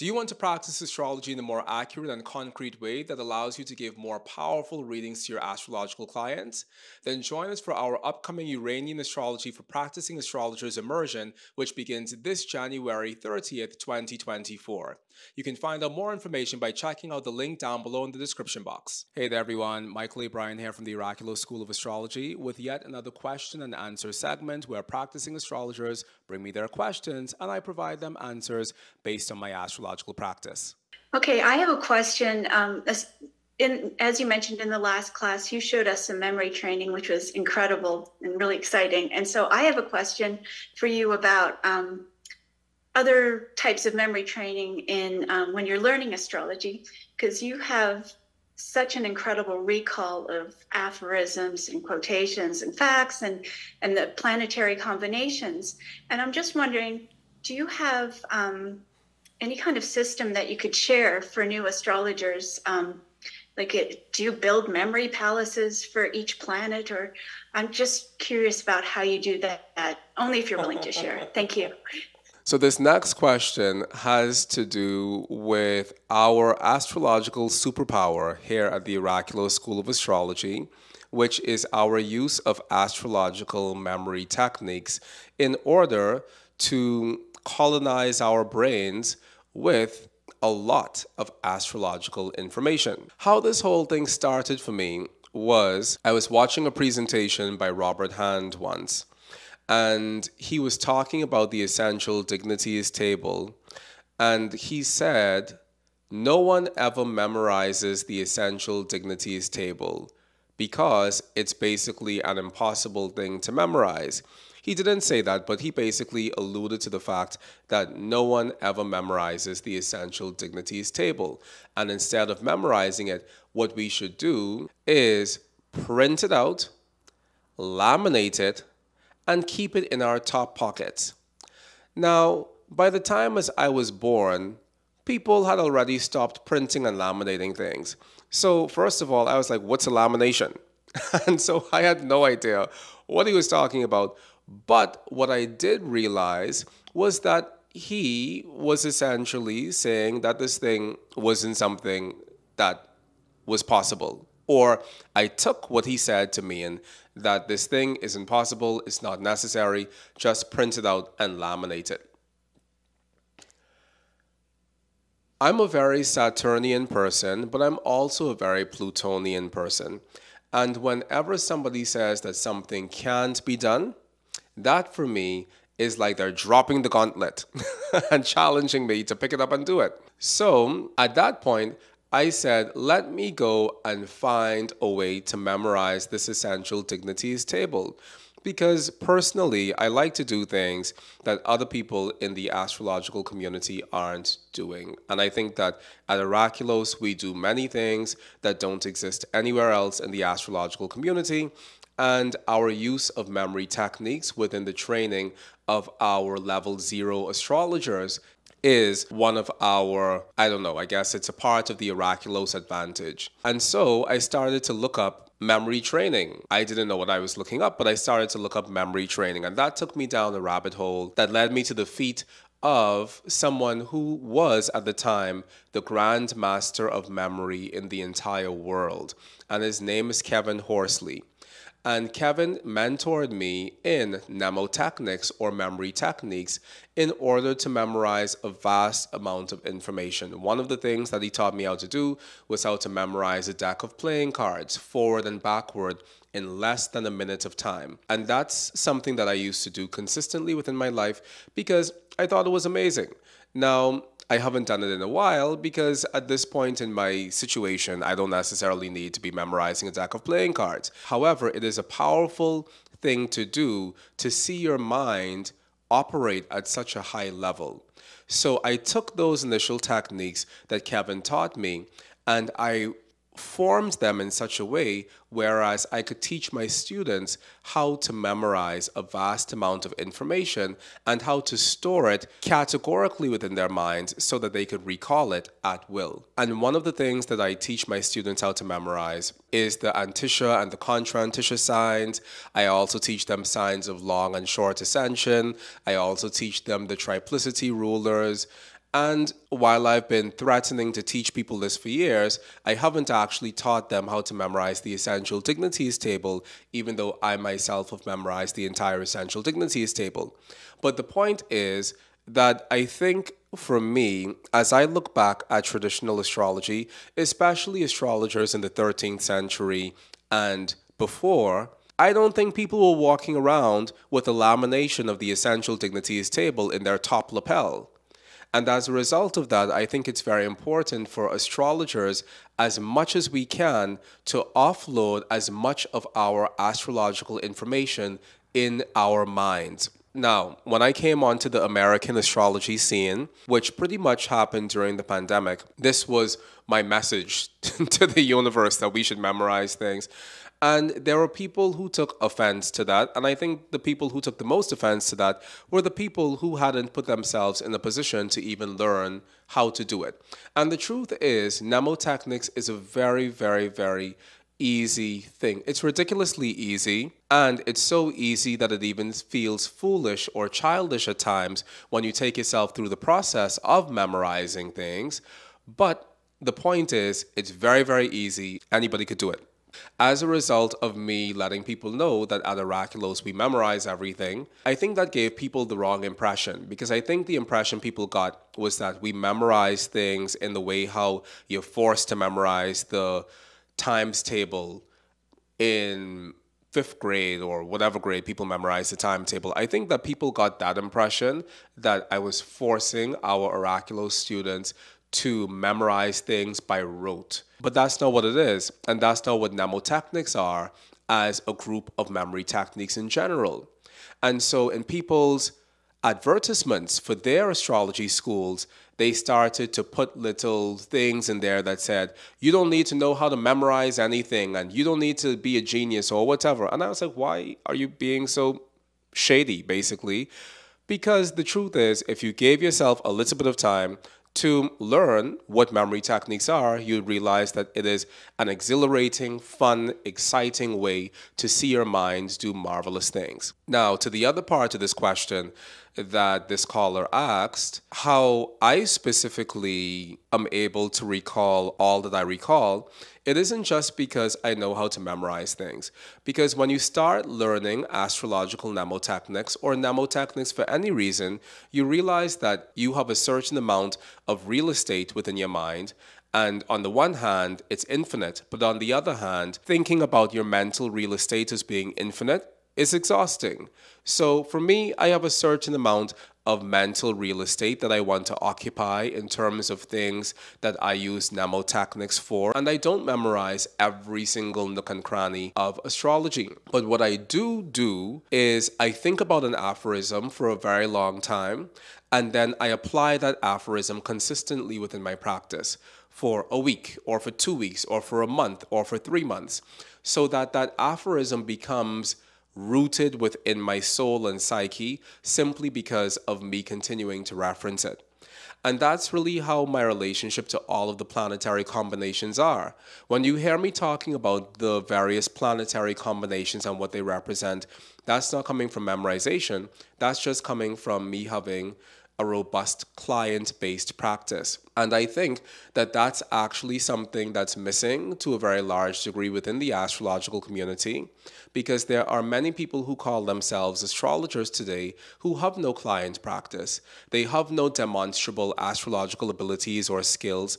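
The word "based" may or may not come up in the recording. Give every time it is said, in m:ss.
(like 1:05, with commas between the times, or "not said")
0:29, 8:43.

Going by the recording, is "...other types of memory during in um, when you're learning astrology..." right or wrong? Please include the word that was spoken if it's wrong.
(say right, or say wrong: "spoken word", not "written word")
wrong: "training", not "during".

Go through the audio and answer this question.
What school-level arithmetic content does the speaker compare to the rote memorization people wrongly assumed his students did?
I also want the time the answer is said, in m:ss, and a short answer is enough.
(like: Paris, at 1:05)
Times table, at 6:33.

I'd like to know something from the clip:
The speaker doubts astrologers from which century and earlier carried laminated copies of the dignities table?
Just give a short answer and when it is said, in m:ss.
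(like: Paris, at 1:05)
13th century, at 5:18.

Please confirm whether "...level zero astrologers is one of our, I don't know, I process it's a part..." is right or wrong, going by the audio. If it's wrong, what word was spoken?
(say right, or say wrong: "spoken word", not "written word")
wrong: "guess", not "process".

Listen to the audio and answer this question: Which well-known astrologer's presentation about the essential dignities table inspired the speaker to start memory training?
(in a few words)
Robert Hand.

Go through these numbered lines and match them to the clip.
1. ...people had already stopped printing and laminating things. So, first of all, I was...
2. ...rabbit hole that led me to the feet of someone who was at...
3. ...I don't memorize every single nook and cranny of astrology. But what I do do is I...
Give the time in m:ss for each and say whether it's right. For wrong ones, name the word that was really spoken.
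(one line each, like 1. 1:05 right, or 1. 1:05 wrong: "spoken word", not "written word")
1. 2:15 right
2. 3:40 right
3. 8:02 right.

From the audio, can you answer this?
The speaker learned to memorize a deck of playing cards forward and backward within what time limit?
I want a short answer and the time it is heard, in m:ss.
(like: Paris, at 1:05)
Less than a minute, at 4:06.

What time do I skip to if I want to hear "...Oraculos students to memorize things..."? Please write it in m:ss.
6:43.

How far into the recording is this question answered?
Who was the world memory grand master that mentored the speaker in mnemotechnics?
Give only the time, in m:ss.
3:50.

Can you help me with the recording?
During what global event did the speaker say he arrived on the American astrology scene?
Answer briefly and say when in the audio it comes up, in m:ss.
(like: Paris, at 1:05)
The pandemic, at 5:44.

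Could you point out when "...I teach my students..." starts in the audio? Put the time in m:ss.
4:47.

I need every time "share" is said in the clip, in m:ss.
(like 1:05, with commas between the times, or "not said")
1:00, 1:10.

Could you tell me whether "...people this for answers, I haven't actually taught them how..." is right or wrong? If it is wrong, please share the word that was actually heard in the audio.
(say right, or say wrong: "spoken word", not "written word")
wrong: "years", not "answers".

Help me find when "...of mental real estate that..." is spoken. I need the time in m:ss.
7:56.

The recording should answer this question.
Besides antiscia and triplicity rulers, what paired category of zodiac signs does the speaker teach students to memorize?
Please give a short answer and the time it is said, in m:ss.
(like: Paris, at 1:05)
Signs of long and short ascension, at 4:53.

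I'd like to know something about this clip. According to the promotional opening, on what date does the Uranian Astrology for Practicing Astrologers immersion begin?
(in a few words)
January 30th, 2024.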